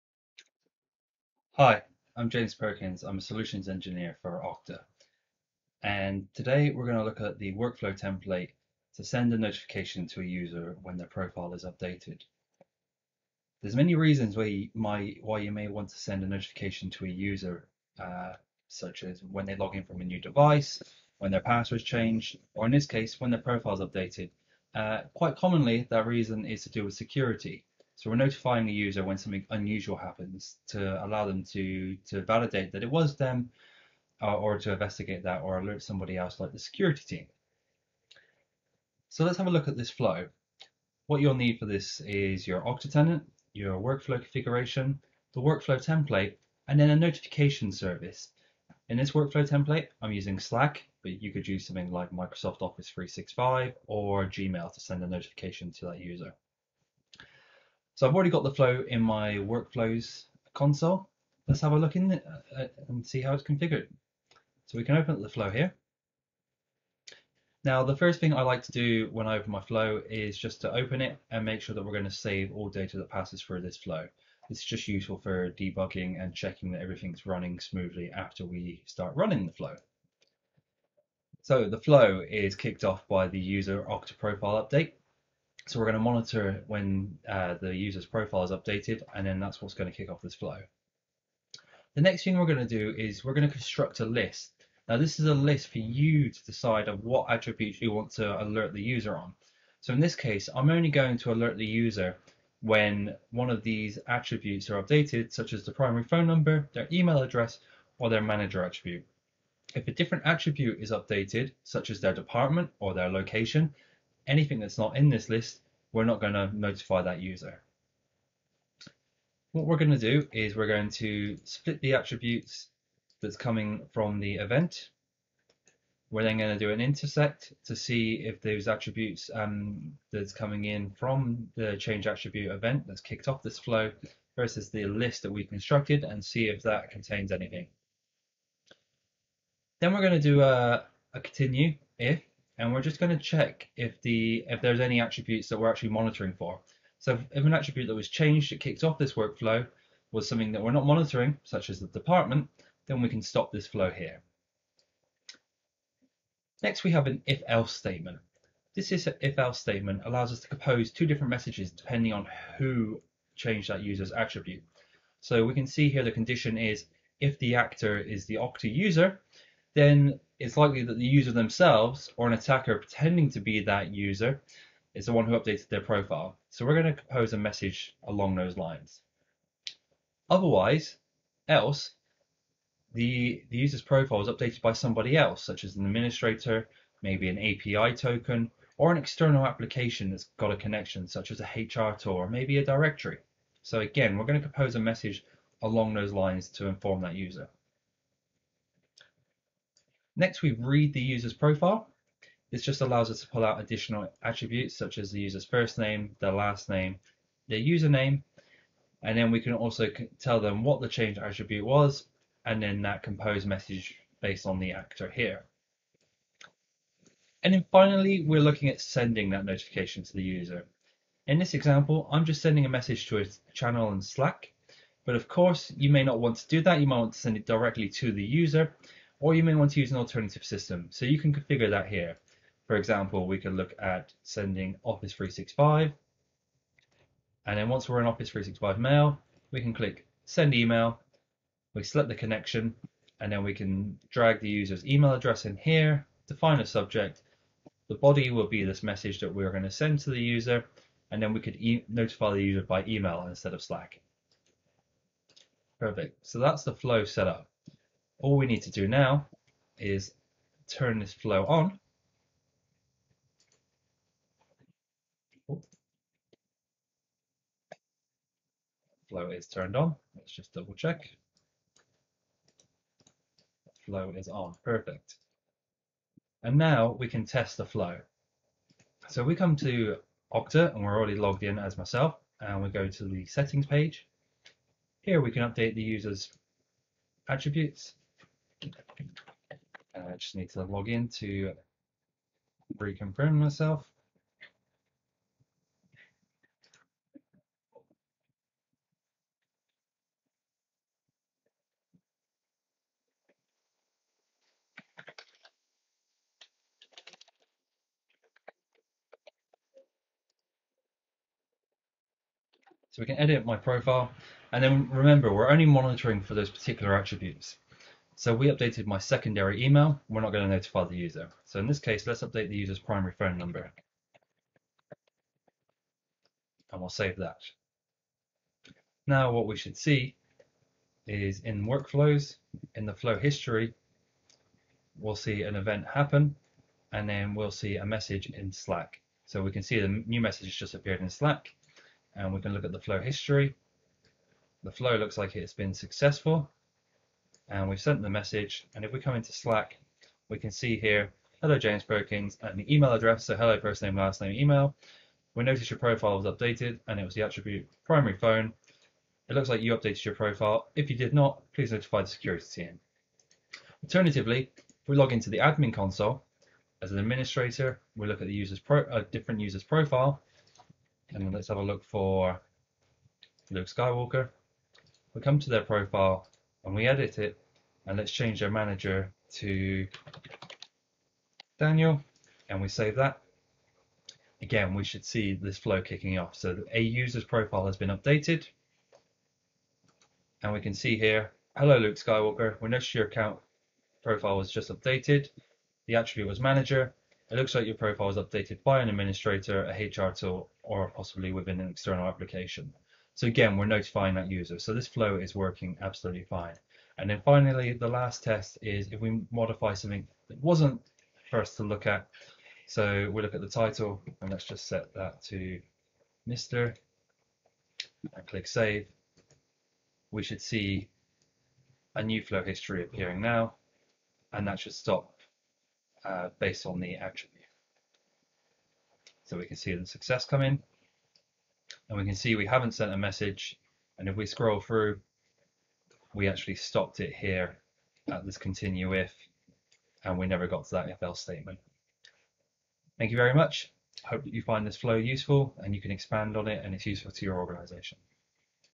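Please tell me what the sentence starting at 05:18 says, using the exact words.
So we updated my secondary email, we're not going to notify the user.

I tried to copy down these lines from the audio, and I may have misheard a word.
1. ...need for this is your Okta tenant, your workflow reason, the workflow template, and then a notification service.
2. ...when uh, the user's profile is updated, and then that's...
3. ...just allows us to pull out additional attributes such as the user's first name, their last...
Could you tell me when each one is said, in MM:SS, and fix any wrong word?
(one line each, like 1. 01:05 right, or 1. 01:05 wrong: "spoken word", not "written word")
1. 00:41 wrong: "configuration", not "reason"
2. 01:26 right
3. 03:22 right.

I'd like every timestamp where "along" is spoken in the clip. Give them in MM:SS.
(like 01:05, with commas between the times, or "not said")
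02:58, 03:15.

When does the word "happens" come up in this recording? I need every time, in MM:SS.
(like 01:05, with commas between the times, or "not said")
00:29, 05:35.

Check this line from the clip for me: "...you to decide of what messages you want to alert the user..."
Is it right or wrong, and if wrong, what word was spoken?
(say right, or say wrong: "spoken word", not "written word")
wrong: "attributes", not "messages".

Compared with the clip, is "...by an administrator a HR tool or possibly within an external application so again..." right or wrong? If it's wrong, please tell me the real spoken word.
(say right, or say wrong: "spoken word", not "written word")
right.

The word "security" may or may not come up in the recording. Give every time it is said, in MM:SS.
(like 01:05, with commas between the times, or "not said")
00:26, 00:36, 06:02.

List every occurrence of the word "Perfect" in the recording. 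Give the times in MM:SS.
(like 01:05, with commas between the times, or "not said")
04:15, 04:34.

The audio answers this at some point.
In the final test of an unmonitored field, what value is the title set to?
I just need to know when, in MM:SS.
06:56.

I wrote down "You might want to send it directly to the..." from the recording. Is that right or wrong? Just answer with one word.
right.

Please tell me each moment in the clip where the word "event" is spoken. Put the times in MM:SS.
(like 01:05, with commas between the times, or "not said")
02:04, 02:12, 05:35.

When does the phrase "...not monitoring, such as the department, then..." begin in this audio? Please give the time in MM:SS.
02:30.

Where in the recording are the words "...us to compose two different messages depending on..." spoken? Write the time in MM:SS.
02:40.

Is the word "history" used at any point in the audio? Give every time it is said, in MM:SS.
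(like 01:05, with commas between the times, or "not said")
05:33, 05:43, 07:02.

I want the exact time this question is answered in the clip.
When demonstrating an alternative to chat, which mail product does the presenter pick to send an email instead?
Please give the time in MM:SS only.
03:58.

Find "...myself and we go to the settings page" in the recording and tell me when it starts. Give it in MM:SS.
04:41.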